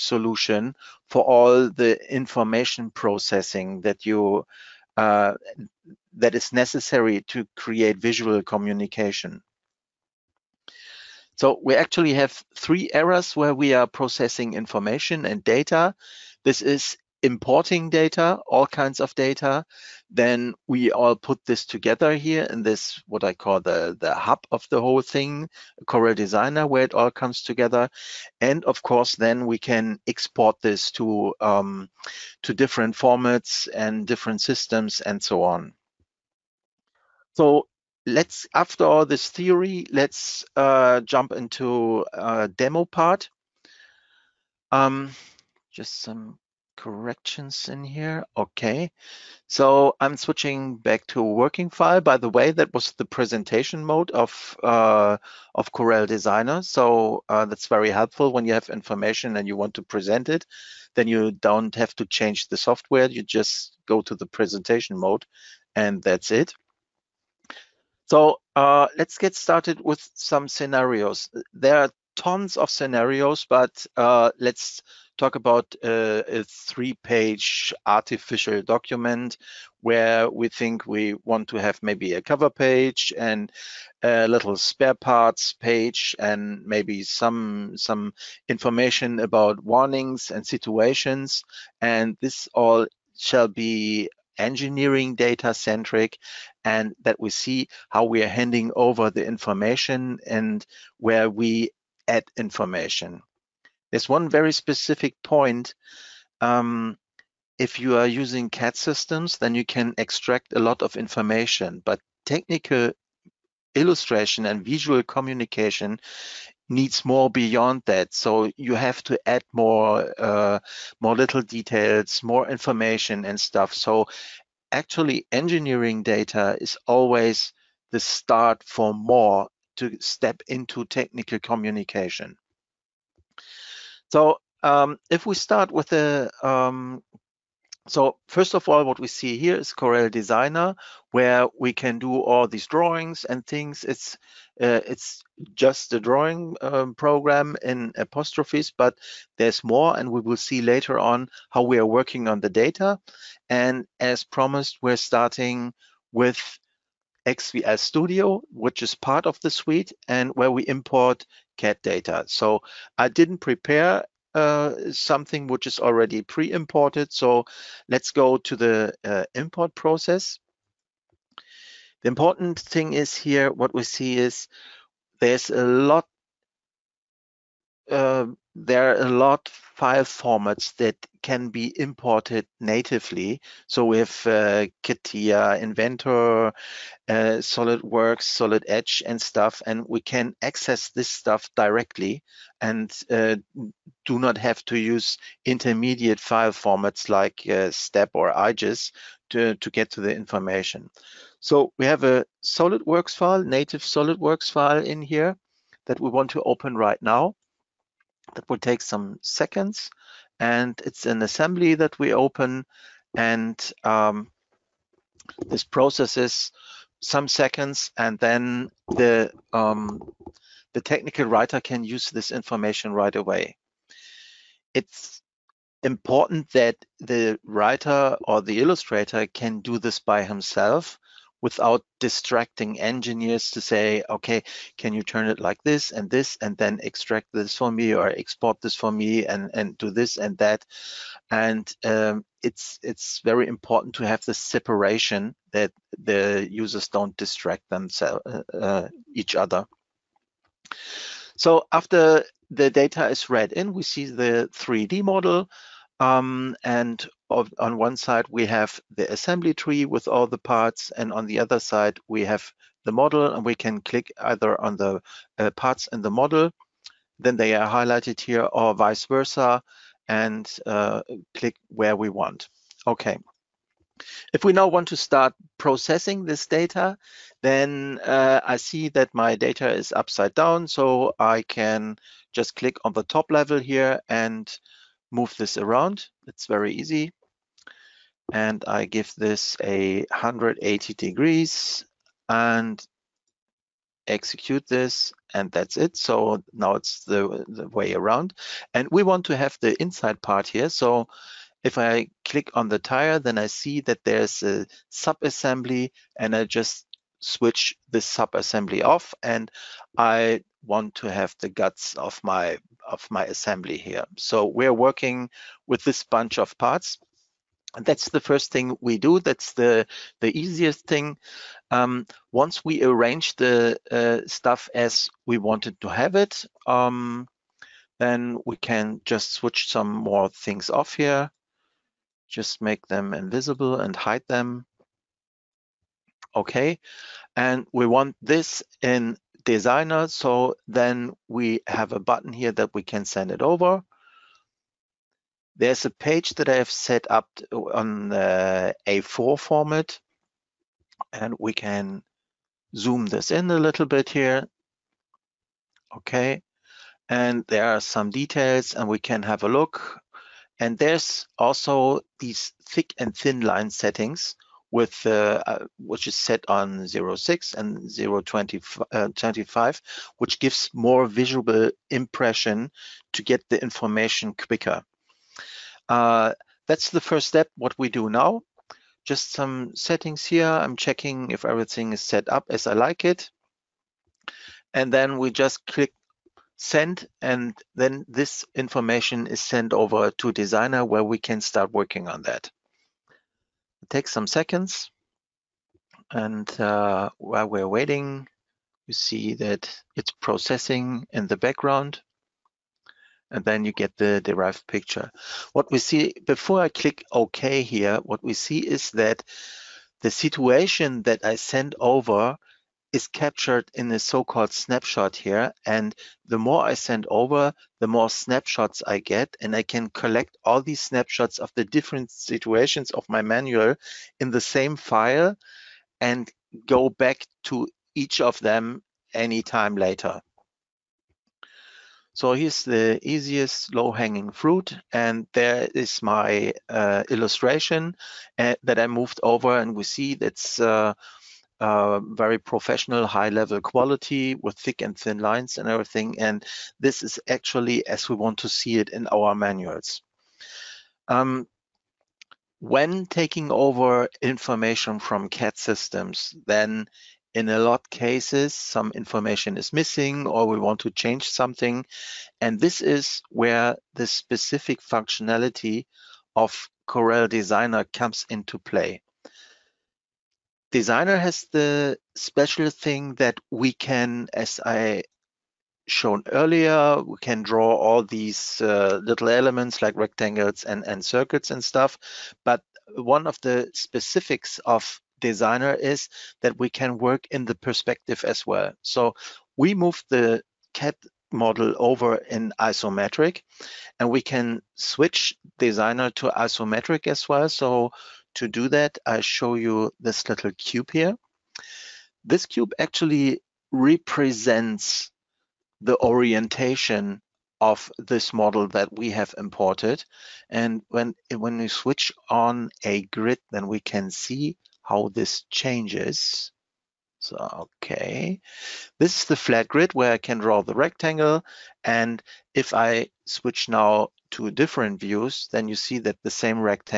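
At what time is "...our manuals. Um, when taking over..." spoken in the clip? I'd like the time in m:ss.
7:29.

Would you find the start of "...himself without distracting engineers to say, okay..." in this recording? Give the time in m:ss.
3:50.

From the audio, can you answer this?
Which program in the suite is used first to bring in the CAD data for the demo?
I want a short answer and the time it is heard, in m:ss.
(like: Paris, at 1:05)
XVL Studio, at 2:37.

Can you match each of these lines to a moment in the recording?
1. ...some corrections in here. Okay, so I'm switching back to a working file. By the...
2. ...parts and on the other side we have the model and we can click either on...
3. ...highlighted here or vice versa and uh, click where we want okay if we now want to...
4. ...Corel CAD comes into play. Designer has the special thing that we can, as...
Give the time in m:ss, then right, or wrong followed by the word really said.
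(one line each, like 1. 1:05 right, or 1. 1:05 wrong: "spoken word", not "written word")
1. 0:46 right
2. 4:20 right
3. 4:27 right
4. 7:46 wrong: "Designer", not "CAD".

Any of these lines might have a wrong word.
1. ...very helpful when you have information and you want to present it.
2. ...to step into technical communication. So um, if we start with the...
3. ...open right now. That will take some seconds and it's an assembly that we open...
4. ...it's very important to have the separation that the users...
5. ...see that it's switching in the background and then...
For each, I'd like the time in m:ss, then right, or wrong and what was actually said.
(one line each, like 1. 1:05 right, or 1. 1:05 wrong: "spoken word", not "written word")
1. 0:57 right
2. 2:09 right
3. 3:26 right
4. 4:02 right
5. 6:38 wrong: "processing", not "switching".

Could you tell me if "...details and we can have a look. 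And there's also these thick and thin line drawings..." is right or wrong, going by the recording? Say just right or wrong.
wrong.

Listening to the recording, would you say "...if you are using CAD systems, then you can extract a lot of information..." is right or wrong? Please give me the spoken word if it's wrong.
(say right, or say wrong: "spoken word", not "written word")
right.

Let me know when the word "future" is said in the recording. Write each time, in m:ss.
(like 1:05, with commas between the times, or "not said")
not said.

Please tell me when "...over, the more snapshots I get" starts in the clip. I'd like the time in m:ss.
6:57.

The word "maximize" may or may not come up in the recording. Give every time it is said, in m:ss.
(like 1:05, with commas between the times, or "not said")
not said.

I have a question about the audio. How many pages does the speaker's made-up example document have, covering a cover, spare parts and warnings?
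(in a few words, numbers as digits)
3.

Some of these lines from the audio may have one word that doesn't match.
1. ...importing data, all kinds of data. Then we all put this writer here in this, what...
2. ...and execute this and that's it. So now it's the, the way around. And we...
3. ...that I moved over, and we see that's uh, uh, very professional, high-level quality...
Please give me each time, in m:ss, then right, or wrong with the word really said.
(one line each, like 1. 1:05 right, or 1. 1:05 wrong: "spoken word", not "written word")
1. 0:17 wrong: "together", not "writer"
2. 4:52 right
3. 7:18 right.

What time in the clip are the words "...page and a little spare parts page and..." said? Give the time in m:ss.
1:22.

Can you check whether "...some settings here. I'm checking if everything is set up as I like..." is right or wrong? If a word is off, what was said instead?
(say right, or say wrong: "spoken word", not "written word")
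right.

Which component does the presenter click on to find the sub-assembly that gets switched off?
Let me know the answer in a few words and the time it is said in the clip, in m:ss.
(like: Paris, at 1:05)
the tire, at 5:02.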